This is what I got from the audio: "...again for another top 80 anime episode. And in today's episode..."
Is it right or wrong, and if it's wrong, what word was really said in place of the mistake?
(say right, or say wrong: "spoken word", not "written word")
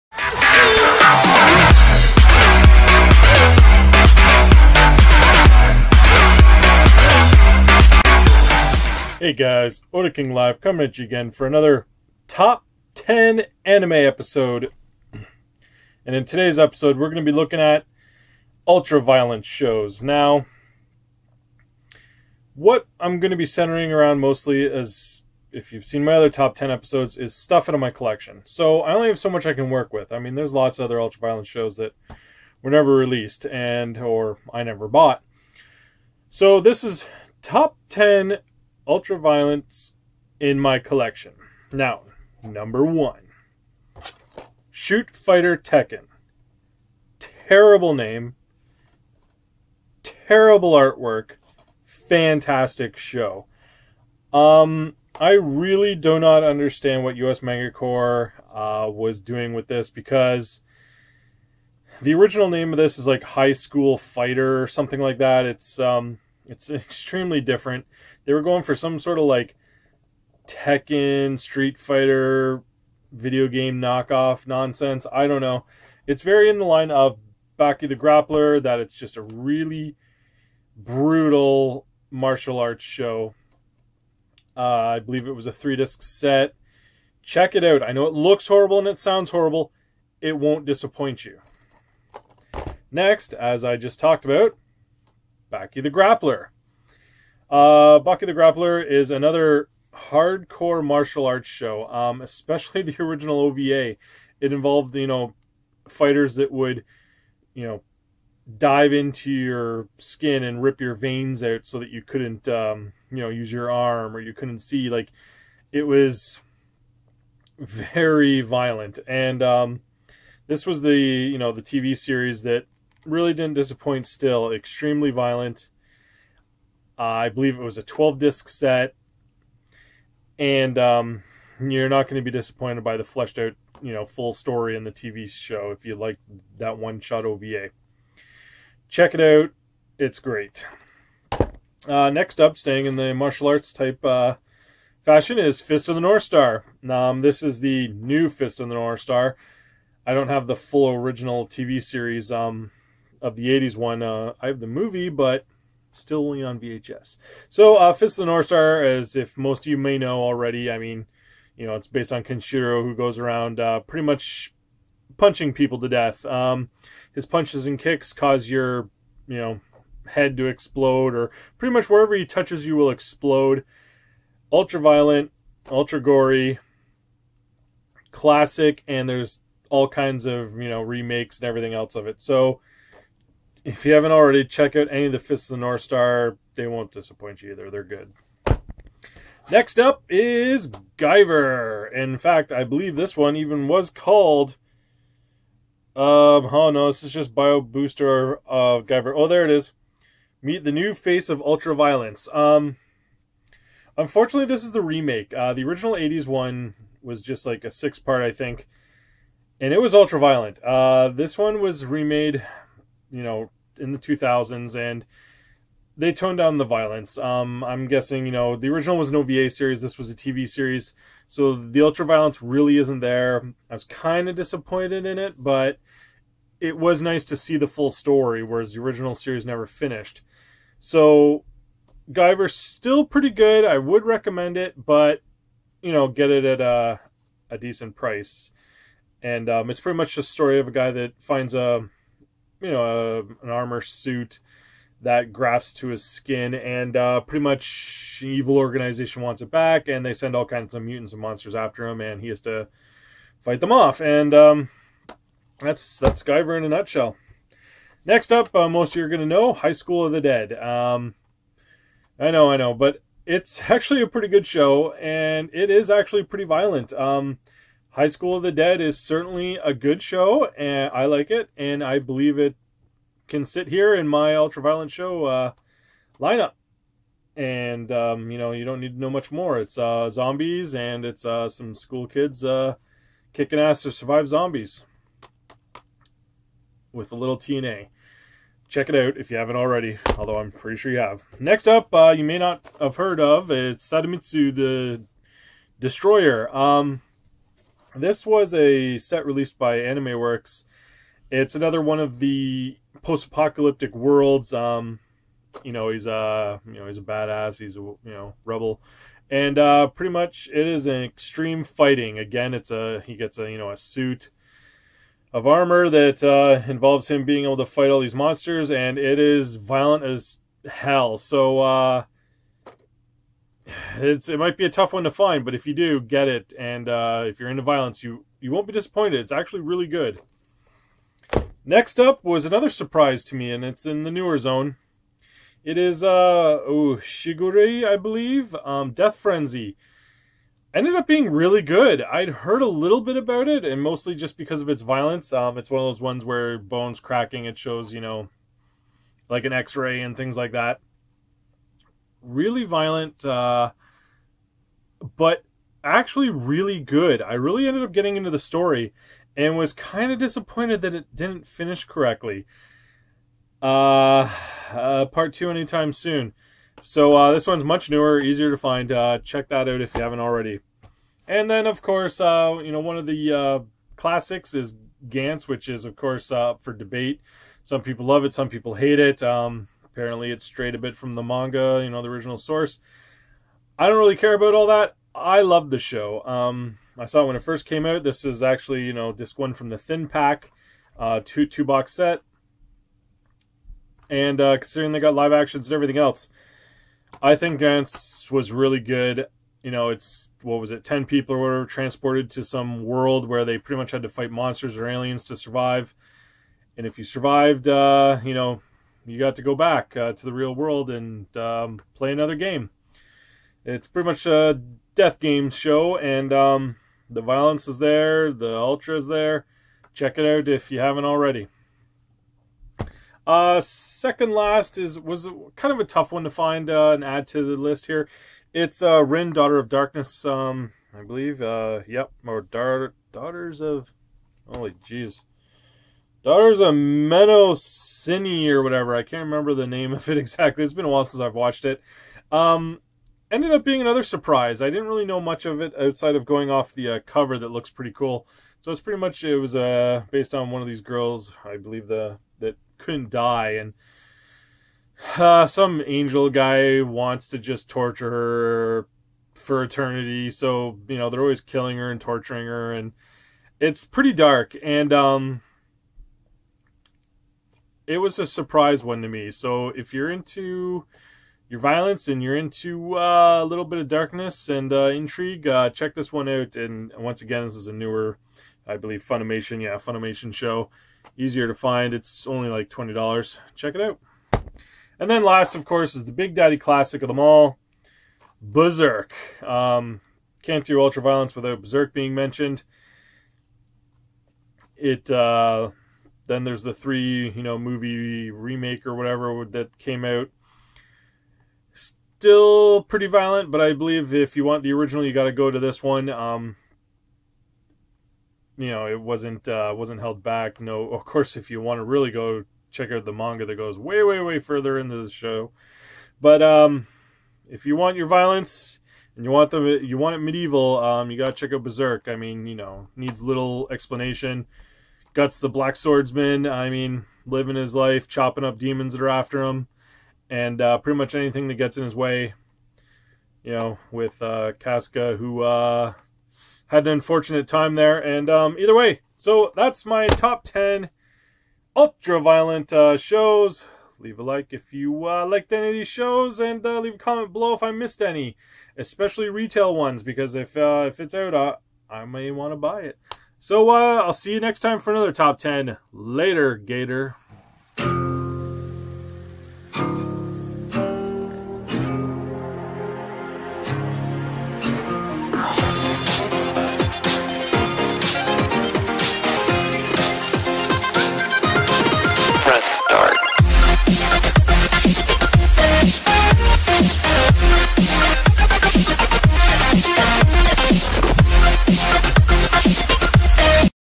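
wrong: "10", not "80".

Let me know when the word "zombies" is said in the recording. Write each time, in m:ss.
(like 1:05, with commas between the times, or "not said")
4:40, 4:44.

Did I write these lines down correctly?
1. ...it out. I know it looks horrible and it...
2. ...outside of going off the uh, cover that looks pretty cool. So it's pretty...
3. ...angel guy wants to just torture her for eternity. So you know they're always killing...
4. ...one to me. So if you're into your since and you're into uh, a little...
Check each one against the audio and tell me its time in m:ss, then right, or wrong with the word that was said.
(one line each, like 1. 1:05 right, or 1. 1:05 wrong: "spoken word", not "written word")
1. 1:27 right
2. 7:25 right
3. 7:35 right
4. 7:48 wrong: "violence", not "since".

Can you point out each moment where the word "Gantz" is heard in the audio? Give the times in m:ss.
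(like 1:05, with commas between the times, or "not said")
6:15, 6:37.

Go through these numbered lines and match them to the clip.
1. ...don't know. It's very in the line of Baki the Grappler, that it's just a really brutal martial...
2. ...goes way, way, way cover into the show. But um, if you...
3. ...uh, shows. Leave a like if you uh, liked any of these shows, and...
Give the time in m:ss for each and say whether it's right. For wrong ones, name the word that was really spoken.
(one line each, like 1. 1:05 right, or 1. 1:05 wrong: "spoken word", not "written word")
1. 1:15 right
2. 8:33 wrong: "further", not "cover"
3. 9:02 right.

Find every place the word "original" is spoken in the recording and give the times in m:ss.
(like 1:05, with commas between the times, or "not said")
1:02, 1:43, 2:30, 3:25, 3:38, 3:48, 6:22, 8:24.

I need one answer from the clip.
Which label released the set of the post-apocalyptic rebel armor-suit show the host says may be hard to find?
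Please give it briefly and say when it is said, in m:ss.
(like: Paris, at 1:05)
Anime Works, at 4:59.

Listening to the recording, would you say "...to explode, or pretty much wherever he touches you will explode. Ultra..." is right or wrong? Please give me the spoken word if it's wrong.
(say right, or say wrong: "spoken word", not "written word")
right.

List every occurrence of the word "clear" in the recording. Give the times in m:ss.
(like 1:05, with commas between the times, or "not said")
not said.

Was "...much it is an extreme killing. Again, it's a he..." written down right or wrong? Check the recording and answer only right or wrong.
wrong.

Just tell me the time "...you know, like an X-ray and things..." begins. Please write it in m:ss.
5:47.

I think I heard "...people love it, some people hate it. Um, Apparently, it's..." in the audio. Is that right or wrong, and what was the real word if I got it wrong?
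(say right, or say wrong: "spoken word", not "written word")
right.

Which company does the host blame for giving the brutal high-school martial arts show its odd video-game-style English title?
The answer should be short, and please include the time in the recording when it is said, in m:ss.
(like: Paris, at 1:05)
US Corps, at 0:57.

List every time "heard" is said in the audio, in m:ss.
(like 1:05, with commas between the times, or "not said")
4:52, 5:42.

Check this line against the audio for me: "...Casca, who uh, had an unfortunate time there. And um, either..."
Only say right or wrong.
right.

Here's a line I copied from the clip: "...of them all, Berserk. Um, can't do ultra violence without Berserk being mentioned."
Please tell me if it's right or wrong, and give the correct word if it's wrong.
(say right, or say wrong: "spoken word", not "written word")
right.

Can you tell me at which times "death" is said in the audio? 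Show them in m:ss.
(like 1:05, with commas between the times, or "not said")
2:45, 5:38, 6:54.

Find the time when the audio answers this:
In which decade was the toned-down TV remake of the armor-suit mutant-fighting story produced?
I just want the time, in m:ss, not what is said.
3:33.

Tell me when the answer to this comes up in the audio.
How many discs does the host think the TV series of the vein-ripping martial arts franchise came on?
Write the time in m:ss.
2:07.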